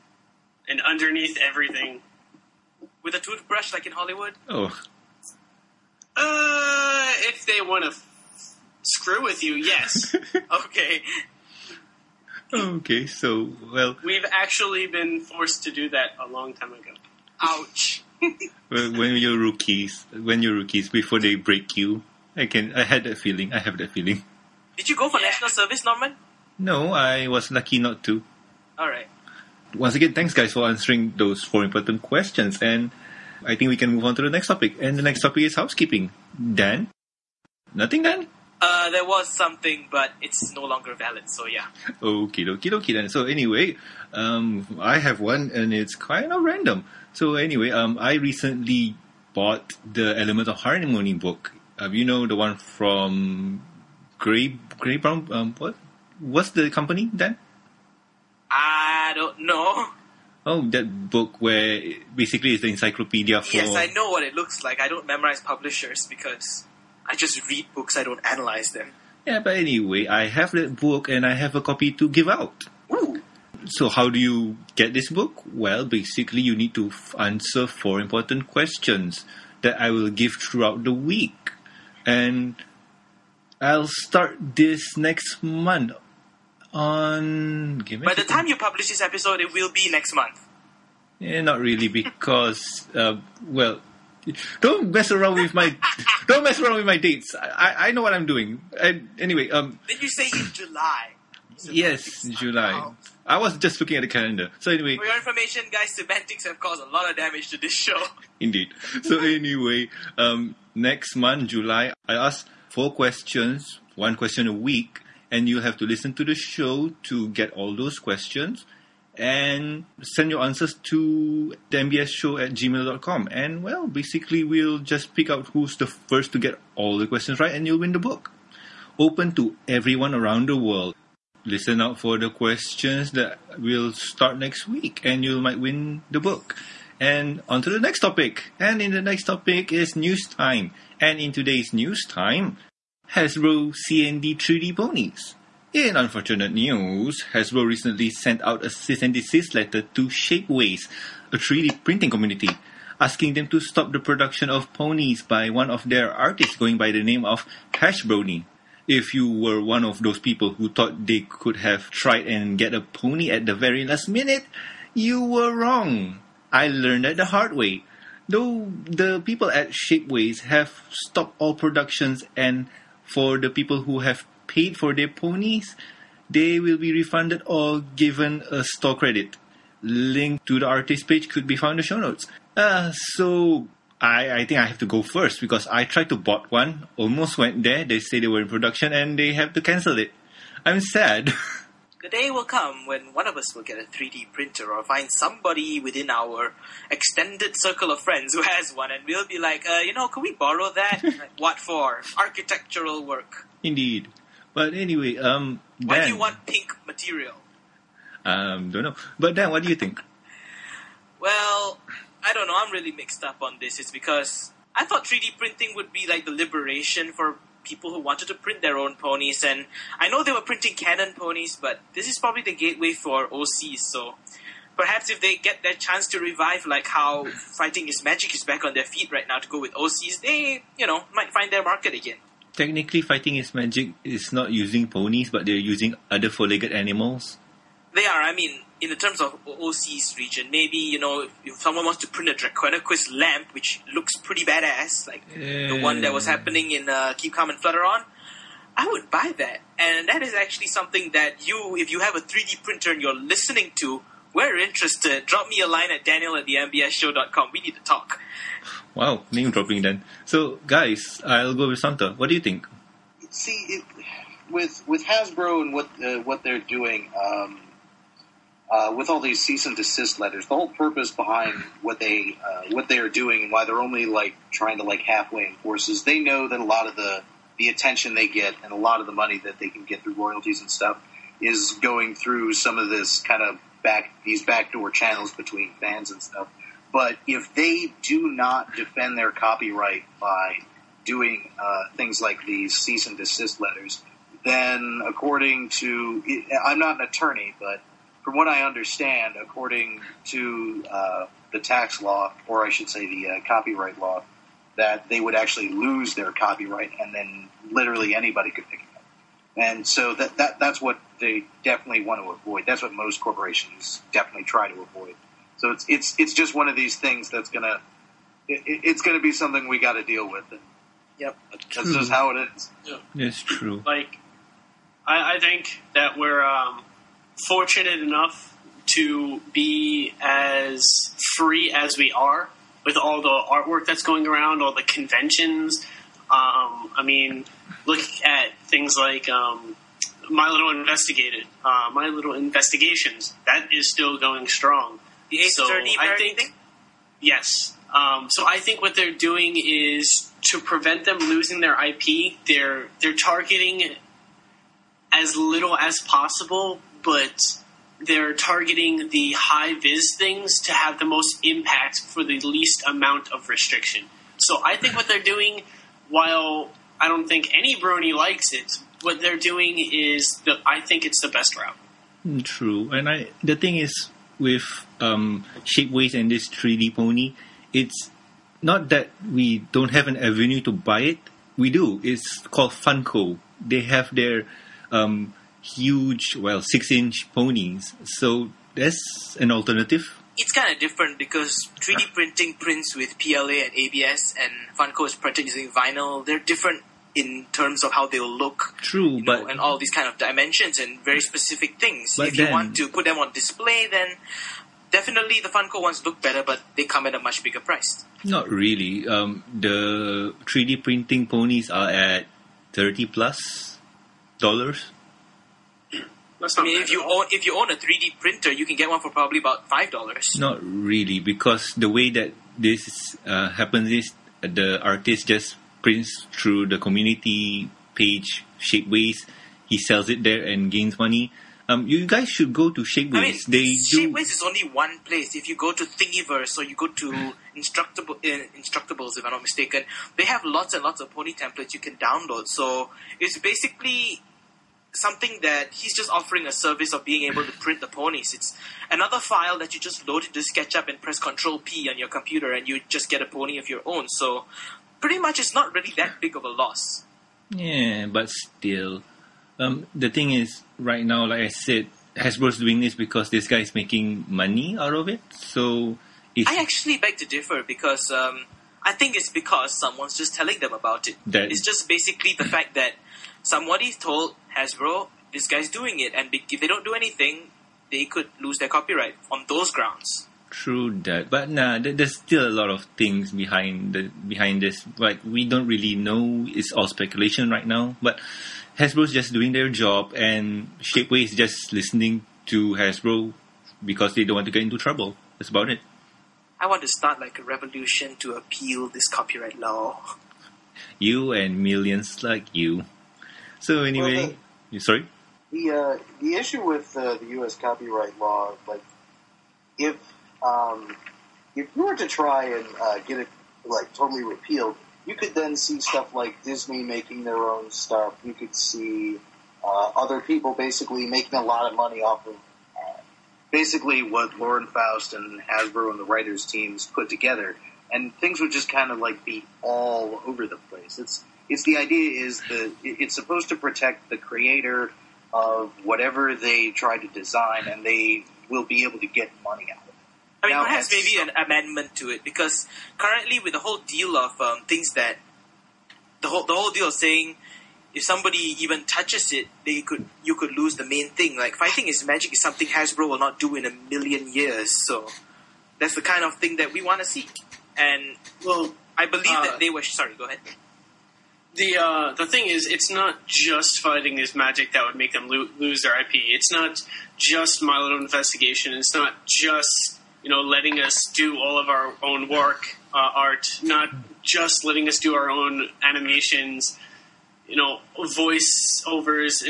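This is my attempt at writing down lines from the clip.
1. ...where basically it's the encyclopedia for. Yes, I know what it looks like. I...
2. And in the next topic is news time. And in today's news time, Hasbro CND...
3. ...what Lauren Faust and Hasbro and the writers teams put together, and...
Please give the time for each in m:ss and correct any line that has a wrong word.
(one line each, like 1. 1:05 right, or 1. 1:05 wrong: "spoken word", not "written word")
1. 1:01 right
2. 2:18 right
3. 8:44 right.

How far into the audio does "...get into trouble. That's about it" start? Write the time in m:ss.
8:14.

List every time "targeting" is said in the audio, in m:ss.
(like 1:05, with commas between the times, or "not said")
5:53, 5:58.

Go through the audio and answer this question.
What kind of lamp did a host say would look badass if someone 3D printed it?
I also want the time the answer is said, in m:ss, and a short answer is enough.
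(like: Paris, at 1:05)
Draconequus lamp, at 4:02.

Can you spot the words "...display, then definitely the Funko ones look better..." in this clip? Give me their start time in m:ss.
6:43.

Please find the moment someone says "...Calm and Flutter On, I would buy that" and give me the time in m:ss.
4:07.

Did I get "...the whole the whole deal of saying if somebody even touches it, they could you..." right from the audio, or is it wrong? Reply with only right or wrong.
right.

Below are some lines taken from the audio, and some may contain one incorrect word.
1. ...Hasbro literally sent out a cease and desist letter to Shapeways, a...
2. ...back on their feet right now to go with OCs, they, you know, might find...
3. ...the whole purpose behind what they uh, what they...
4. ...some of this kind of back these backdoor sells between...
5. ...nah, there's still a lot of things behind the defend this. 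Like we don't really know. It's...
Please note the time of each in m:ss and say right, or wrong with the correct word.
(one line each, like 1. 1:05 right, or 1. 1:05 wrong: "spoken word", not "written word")
1. 2:27 wrong: "recently", not "literally"
2. 3:48 right
3. 4:30 right
4. 4:42 wrong: "channels", not "sells"
5. 8:01 wrong: "behind", not "defend".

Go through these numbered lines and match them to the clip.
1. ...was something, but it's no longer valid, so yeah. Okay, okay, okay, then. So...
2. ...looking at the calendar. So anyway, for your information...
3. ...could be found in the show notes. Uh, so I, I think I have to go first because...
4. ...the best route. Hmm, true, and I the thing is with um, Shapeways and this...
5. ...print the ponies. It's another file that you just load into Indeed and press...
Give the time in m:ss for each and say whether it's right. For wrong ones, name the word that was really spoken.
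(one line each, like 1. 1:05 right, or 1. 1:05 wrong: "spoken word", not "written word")
1. 0:39 right
2. 1:43 right
3. 3:01 right
4. 6:11 right
5. 7:27 wrong: "SketchUp", not "Indeed".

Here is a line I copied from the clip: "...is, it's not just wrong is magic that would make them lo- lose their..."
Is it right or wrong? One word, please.
wrong.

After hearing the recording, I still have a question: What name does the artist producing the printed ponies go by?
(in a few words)
Hashbrony.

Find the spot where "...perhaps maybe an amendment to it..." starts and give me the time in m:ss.
9:00.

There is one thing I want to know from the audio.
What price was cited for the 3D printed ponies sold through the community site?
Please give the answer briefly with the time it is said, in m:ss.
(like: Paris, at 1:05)
$30 plus, at 6:52.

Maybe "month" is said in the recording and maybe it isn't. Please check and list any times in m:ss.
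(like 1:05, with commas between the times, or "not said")
1:25, 1:30, 1:51.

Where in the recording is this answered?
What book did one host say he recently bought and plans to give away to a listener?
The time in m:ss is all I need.
0:50.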